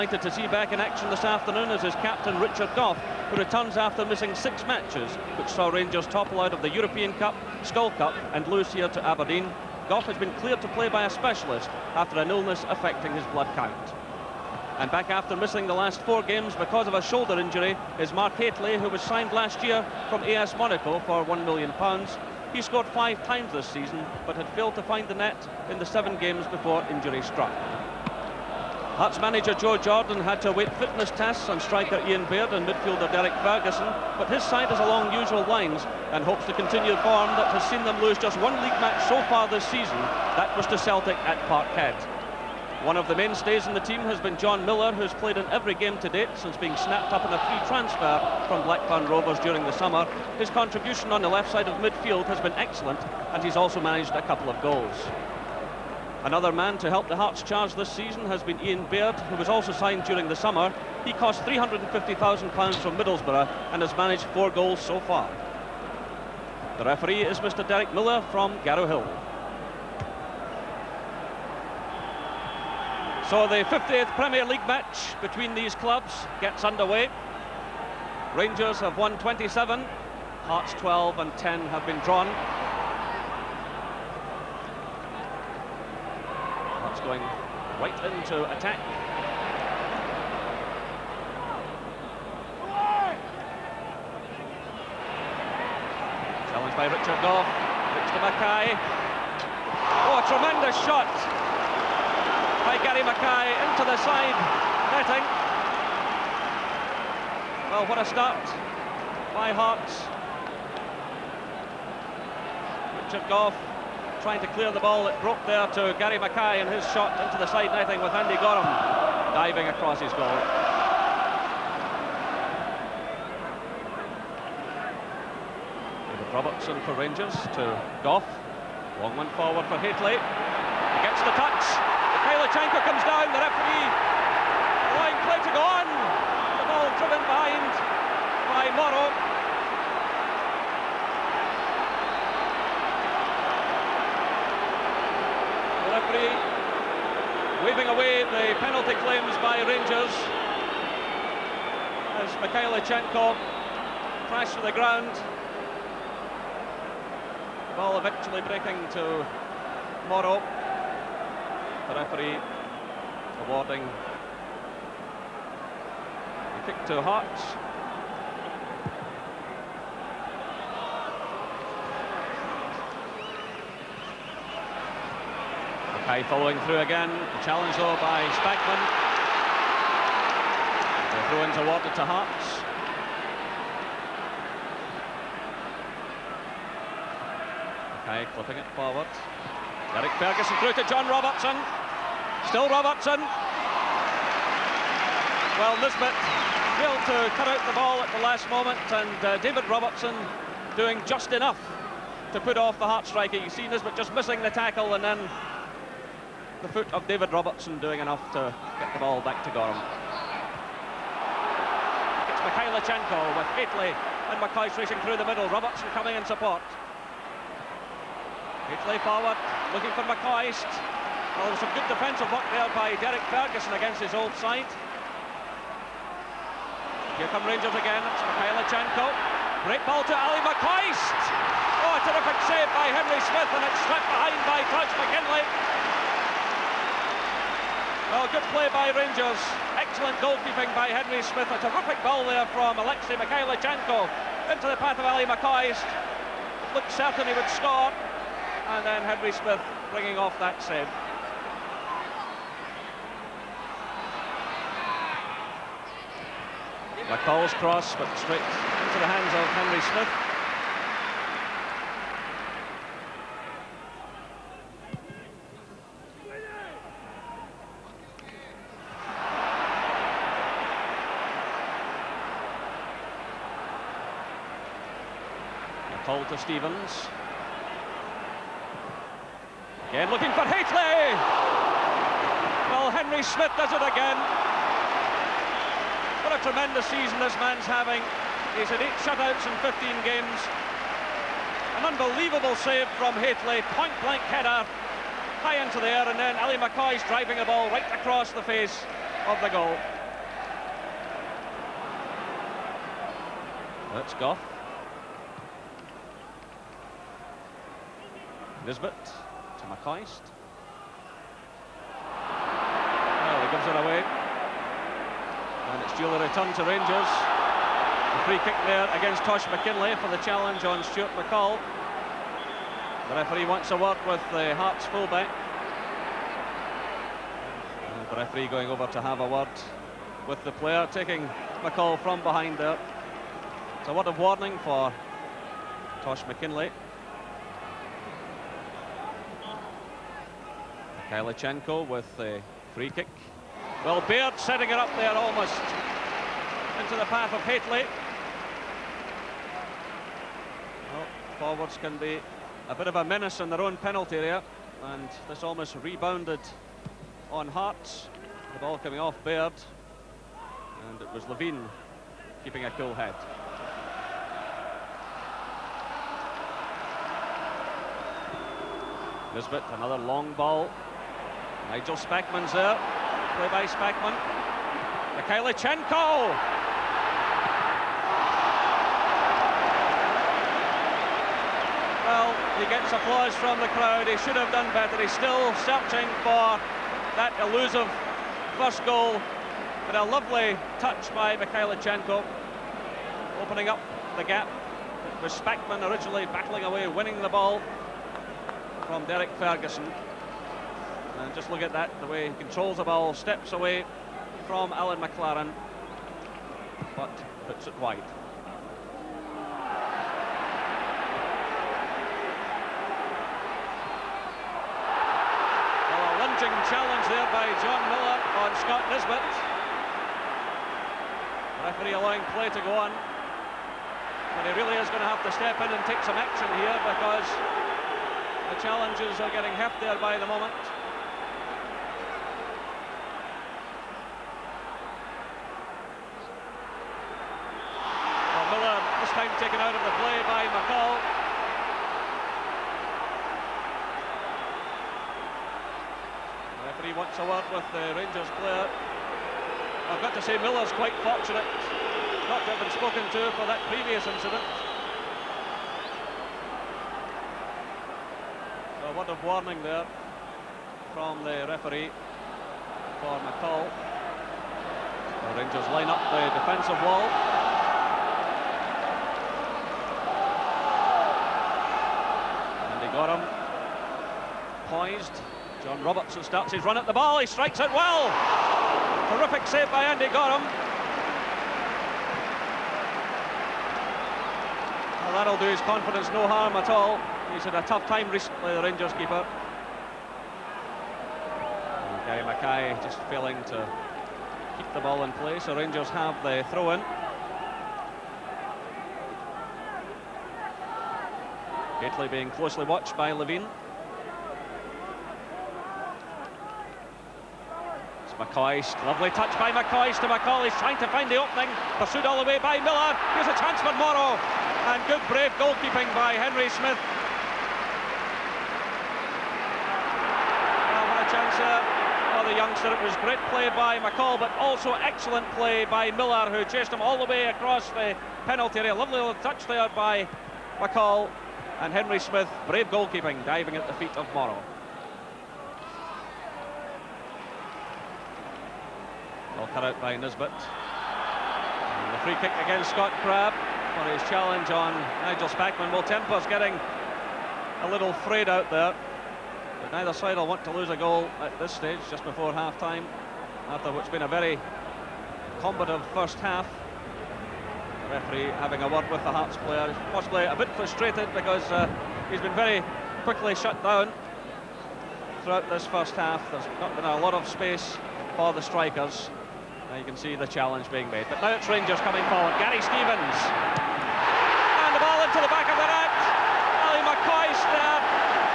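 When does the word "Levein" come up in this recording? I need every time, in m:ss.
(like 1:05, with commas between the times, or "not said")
6:01, 8:23.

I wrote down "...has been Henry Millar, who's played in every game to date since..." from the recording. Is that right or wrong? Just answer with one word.
wrong.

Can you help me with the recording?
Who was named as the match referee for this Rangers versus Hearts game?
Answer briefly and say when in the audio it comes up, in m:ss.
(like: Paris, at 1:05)
Derek Miller, at 1:07.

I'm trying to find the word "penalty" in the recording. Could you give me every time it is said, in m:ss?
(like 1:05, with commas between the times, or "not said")
2:28, 5:53, 8:48.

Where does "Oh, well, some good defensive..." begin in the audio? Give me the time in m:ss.
3:41.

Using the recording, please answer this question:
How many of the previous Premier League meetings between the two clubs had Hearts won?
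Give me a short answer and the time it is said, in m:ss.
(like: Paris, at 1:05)
12, at 1:20.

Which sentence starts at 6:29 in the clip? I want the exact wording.
But a lovely touch by Mikhailichenko, opening up the gap.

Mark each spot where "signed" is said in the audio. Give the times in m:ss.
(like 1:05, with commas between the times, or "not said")
0:18, 0:59.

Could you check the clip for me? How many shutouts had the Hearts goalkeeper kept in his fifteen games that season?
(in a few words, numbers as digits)
8.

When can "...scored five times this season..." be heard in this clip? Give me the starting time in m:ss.
0:22.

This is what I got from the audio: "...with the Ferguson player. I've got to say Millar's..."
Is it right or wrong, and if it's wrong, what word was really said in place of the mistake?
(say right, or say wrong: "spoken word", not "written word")
wrong: "Rangers", not "Ferguson".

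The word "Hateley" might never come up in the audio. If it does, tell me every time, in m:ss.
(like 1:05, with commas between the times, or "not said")
0:18, 2:09, 3:33, 3:38, 4:40, 4:53, 5:47, 8:21.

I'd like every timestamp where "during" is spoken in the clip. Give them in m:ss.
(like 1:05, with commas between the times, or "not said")
0:49, 1:00.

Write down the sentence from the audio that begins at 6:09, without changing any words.
Nisbet, another long ball Nigel Spackman's there.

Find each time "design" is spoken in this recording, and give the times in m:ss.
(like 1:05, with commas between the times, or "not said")
not said.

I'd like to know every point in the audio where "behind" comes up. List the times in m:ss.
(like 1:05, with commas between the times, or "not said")
3:54, 5:32.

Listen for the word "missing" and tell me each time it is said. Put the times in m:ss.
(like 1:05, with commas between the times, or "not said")
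0:04, 0:15, 3:24.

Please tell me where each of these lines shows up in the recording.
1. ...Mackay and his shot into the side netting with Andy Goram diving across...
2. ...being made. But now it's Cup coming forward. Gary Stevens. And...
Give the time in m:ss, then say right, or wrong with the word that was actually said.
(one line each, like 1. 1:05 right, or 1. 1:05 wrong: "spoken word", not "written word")
1. 1:56 right
2. 9:30 wrong: "Rangers", not "Cup".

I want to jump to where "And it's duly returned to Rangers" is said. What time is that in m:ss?
5:15.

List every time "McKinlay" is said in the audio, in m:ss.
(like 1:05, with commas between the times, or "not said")
3:54, 5:19, 5:36.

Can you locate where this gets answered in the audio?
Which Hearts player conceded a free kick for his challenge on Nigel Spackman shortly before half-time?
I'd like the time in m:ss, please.
9:02.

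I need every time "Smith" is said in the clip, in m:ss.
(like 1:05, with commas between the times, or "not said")
3:53, 4:01, 4:09, 4:19, 4:43, 8:36, 8:51.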